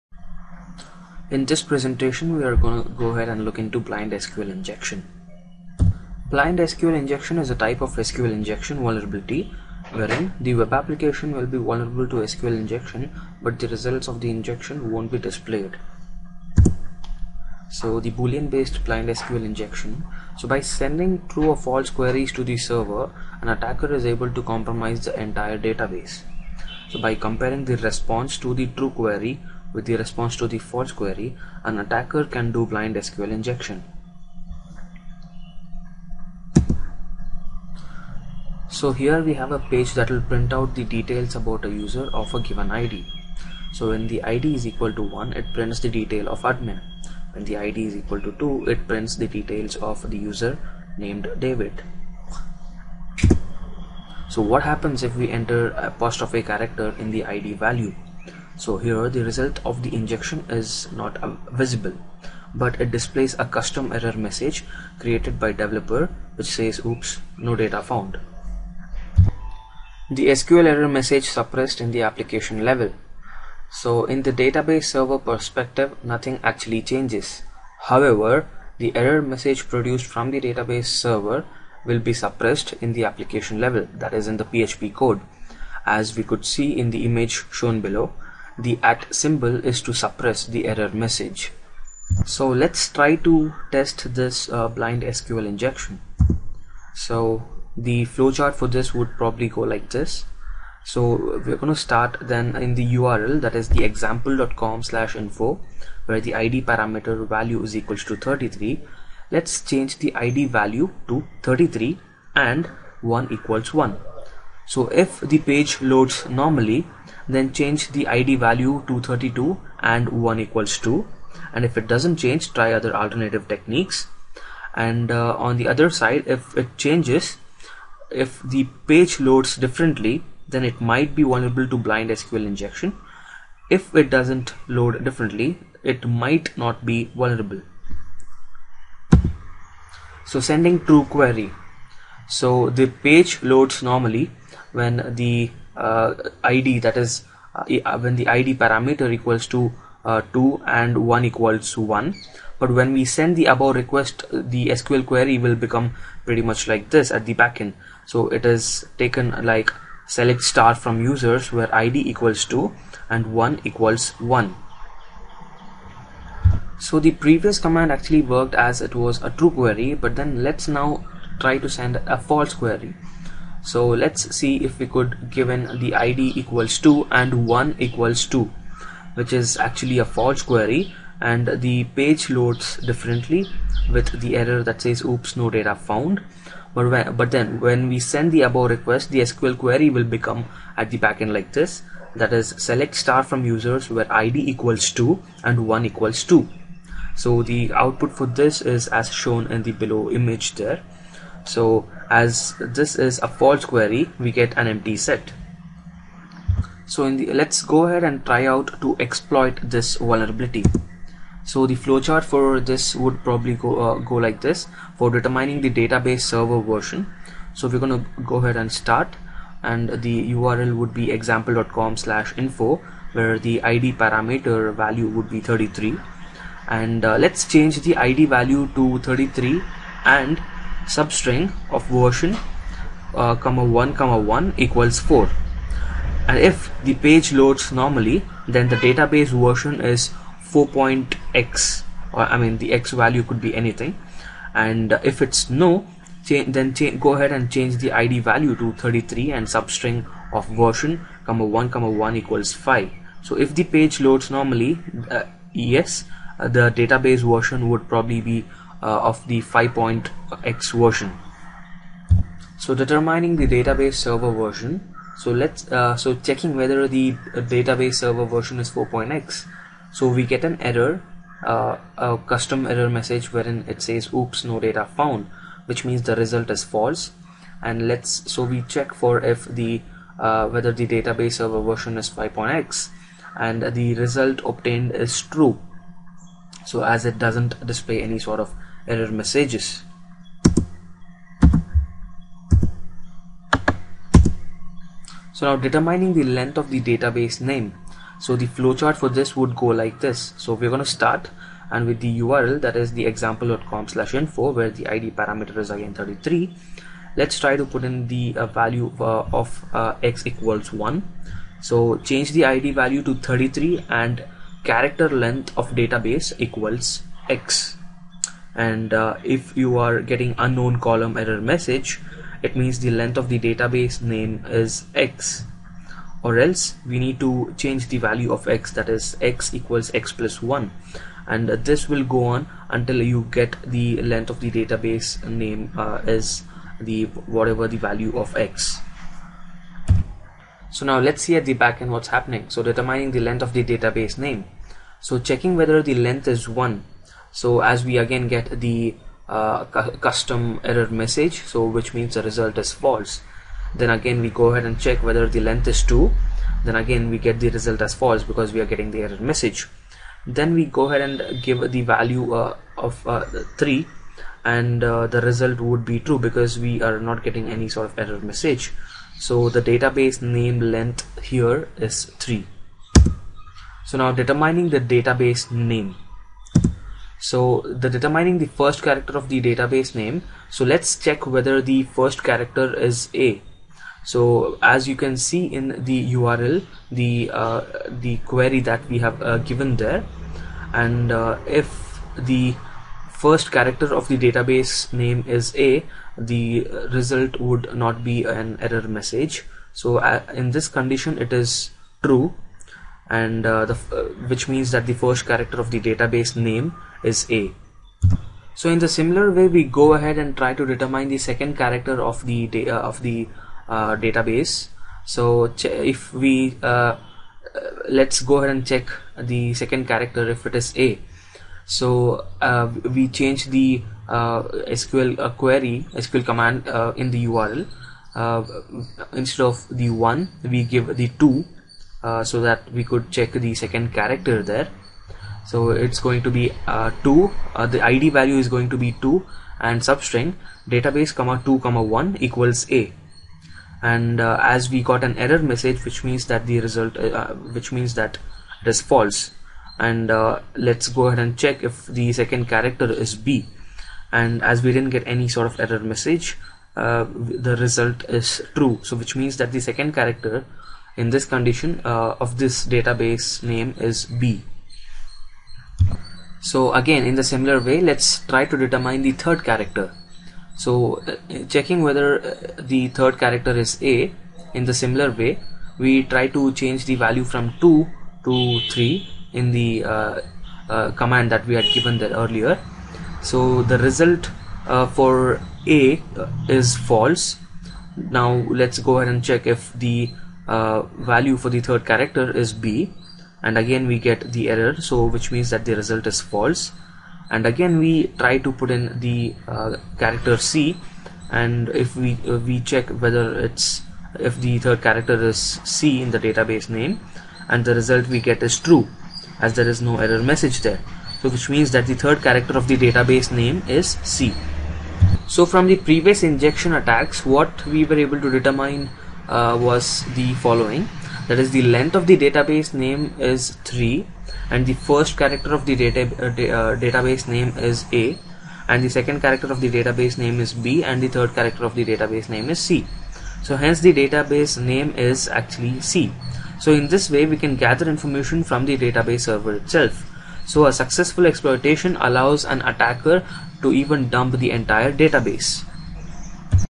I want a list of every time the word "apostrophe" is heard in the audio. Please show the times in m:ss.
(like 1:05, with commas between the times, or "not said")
0:55.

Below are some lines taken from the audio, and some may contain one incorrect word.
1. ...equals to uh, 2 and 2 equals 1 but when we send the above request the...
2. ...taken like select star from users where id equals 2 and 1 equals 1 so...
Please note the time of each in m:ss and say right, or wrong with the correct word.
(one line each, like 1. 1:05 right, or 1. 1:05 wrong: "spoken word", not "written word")
1. 2:29 wrong: "1", not "2"
2. 2:38 right.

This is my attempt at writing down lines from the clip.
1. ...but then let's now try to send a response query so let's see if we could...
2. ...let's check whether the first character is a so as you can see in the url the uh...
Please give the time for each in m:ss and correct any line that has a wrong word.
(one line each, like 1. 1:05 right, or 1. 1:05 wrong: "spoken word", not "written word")
1. 2:49 wrong: "false", not "response"
2. 6:20 right.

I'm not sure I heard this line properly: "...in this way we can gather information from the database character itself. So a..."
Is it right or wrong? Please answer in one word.
wrong.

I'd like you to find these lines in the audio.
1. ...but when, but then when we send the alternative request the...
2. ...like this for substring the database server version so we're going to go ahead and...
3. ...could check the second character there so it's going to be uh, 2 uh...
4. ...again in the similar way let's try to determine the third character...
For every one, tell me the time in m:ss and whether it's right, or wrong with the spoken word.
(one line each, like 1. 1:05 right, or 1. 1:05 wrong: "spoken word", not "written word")
1. 3:06 wrong: "above", not "alternative"
2. 3:34 wrong: "determining", not "substring"
3. 7:12 right
4. 7:46 right.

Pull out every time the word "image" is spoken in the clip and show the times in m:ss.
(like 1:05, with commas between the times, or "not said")
1:27, 3:20.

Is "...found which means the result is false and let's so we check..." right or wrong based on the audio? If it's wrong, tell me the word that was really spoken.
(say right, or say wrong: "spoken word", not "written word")
right.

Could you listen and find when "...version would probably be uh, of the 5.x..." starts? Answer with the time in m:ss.
4:17.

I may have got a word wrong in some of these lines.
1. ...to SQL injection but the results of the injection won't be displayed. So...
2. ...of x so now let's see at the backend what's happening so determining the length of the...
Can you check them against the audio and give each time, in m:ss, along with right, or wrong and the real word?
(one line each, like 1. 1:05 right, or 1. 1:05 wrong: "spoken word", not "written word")
1. 0:12 right
2. 5:38 right.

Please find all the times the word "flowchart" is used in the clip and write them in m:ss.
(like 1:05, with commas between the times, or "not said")
1:38, 3:31, 4:58.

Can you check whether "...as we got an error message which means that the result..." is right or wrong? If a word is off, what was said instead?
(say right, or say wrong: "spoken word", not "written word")
right.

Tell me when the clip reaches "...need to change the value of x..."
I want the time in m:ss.
5:26.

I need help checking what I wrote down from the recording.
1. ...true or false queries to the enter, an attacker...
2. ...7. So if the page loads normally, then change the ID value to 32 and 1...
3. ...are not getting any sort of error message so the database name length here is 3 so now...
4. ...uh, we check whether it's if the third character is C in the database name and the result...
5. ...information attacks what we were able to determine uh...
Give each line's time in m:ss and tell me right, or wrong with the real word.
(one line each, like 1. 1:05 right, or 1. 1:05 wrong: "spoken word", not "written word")
1. 0:21 wrong: "server", not "enter"
2. 1:53 wrong: "1", not "7"
3. 6:06 right
4. 8:22 right
5. 8:36 wrong: "injection", not "information".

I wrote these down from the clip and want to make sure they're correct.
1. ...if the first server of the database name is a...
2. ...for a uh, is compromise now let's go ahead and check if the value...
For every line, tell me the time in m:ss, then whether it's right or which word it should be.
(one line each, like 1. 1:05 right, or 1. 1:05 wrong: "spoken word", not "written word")
1. 6:31 wrong: "character", not "server"
2. 8:04 wrong: "false", not "compromise".